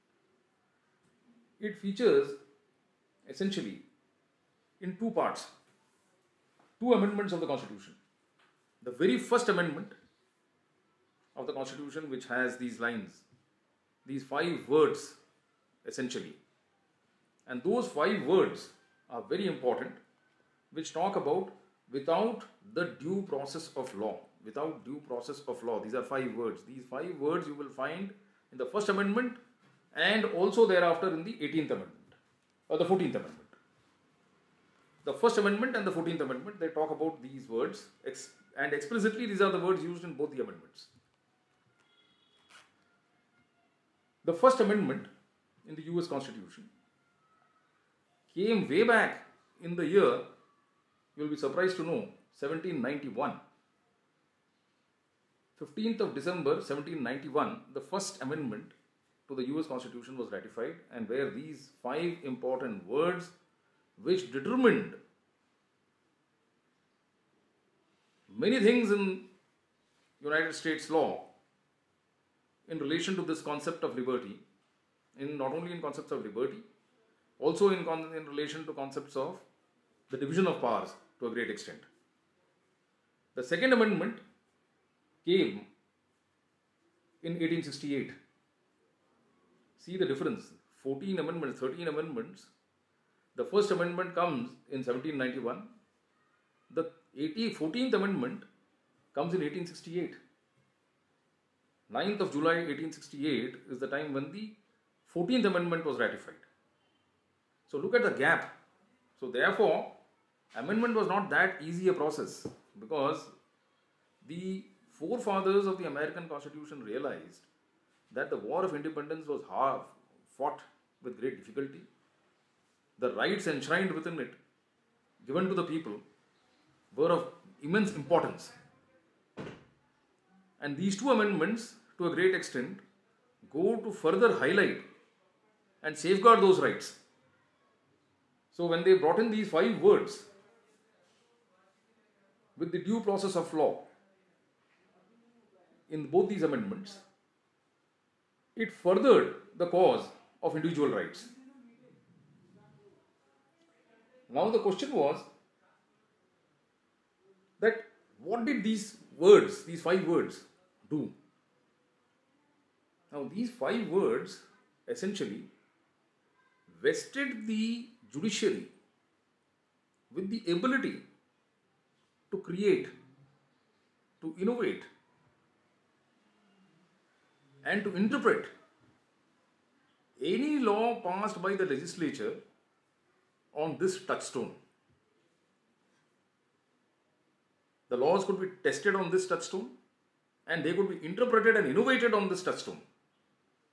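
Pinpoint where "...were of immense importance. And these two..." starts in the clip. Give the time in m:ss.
2:06.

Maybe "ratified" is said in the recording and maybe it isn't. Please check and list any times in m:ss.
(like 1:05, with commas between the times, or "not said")
1:00, 1:45.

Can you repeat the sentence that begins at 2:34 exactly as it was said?
Now, the question was that what did these words, these five words, do?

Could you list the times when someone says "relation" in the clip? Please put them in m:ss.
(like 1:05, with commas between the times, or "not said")
1:12, 1:18.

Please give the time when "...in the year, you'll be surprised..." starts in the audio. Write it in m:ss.
0:49.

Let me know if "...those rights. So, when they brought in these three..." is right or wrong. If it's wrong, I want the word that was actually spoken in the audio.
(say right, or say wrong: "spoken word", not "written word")
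wrong: "five", not "three".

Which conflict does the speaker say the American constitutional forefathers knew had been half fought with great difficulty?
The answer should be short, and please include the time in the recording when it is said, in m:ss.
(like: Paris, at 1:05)
War of Independence, at 1:58.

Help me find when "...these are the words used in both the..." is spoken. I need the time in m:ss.
0:39.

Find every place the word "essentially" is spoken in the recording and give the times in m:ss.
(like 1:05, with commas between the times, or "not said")
0:03, 0:15, 2:44.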